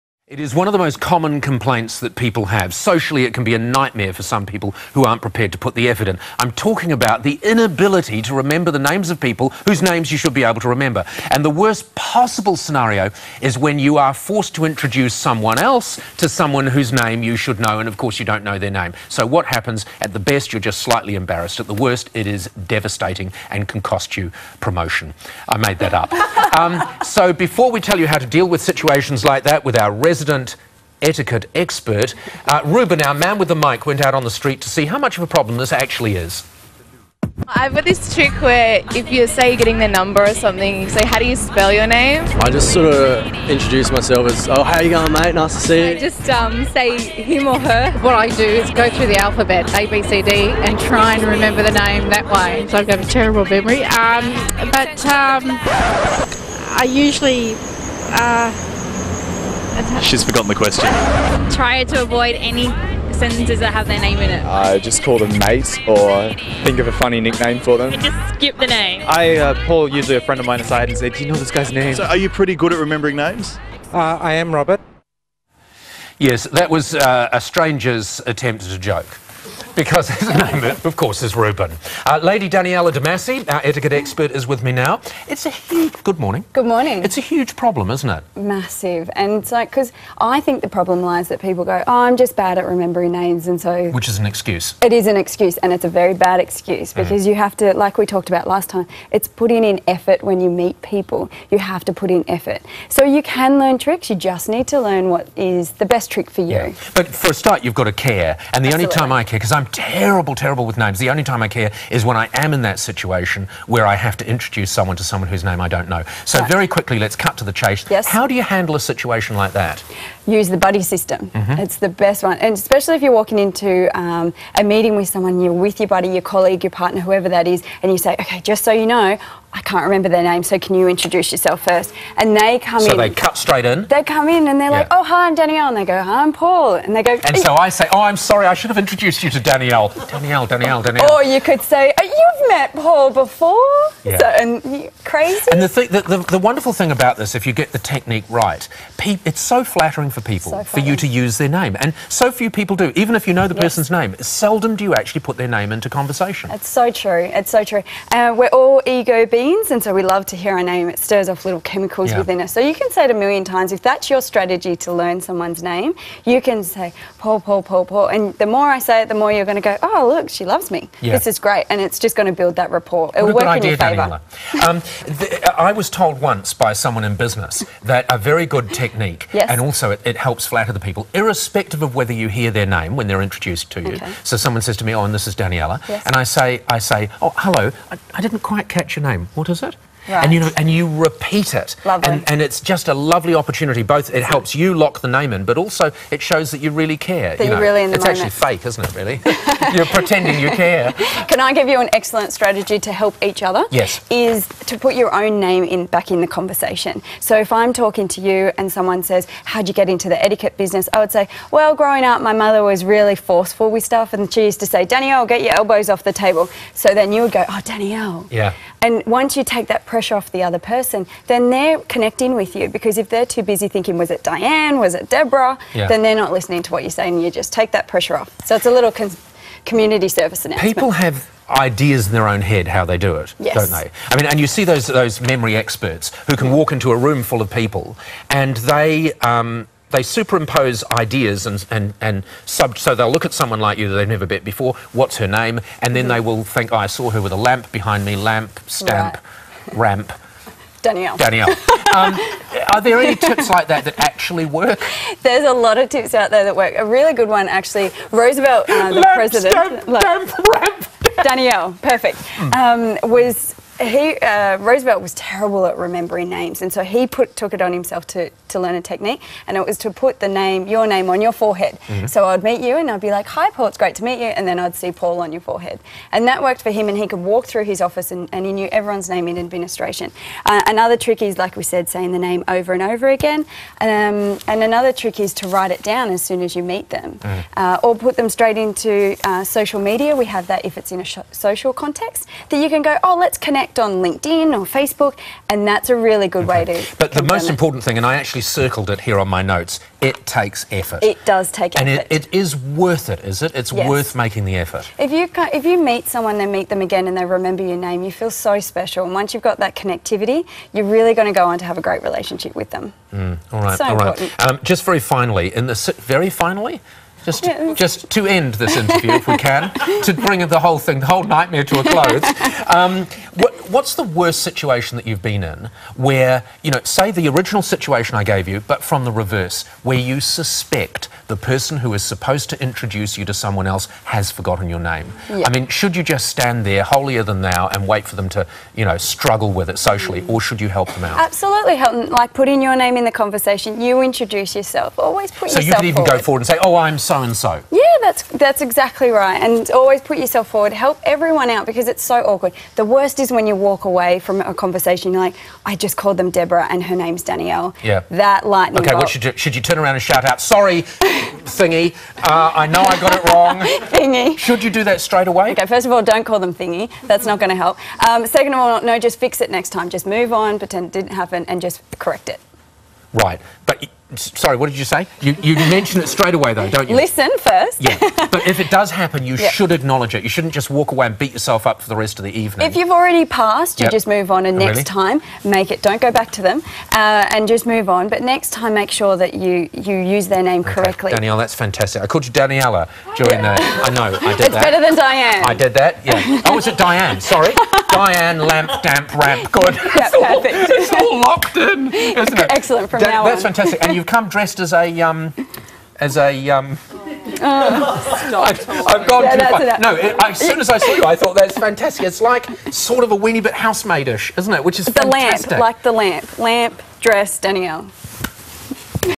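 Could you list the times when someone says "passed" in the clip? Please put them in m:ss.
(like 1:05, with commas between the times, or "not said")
6:23.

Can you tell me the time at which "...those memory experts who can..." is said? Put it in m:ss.
3:54.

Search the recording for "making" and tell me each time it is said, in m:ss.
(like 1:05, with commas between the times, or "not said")
5:04.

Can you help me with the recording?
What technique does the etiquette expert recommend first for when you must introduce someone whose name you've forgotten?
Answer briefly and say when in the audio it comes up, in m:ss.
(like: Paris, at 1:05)
The buddy system, at 2:00.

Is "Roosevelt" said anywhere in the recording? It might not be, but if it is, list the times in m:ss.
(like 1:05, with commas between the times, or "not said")
4:18, 4:24.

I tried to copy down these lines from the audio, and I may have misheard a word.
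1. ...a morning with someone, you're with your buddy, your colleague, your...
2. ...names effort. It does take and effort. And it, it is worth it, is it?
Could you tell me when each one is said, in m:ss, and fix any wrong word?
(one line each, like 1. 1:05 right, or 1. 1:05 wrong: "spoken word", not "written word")
1. 2:04 wrong: "meeting", not "morning"
2. 5:00 wrong: "takes", not "names".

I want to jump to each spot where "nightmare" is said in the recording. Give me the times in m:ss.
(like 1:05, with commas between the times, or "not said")
0:03, 5:21.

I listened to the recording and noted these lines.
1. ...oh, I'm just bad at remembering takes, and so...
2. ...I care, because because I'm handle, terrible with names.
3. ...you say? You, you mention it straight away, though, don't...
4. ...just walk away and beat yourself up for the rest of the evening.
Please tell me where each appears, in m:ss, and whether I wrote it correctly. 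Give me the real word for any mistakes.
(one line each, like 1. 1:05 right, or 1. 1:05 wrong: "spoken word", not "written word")
1. 1:31 wrong: "names", not "takes"
2. 1:49 wrong: "terrible", not "handle"
3. 6:14 right
4. 6:20 right.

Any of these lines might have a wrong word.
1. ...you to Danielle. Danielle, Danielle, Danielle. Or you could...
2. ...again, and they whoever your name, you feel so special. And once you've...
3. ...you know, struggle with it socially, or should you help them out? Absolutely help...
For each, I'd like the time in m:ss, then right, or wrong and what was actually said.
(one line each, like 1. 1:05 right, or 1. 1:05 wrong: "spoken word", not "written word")
1. 2:19 right
2. 5:06 wrong: "remember", not "whoever"
3. 5:38 right.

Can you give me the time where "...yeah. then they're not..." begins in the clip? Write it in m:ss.
3:45.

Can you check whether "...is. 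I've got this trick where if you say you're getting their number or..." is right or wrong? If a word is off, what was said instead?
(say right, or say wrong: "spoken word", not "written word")
right.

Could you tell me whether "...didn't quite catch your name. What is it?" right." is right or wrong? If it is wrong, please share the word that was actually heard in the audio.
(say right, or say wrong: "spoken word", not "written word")
right.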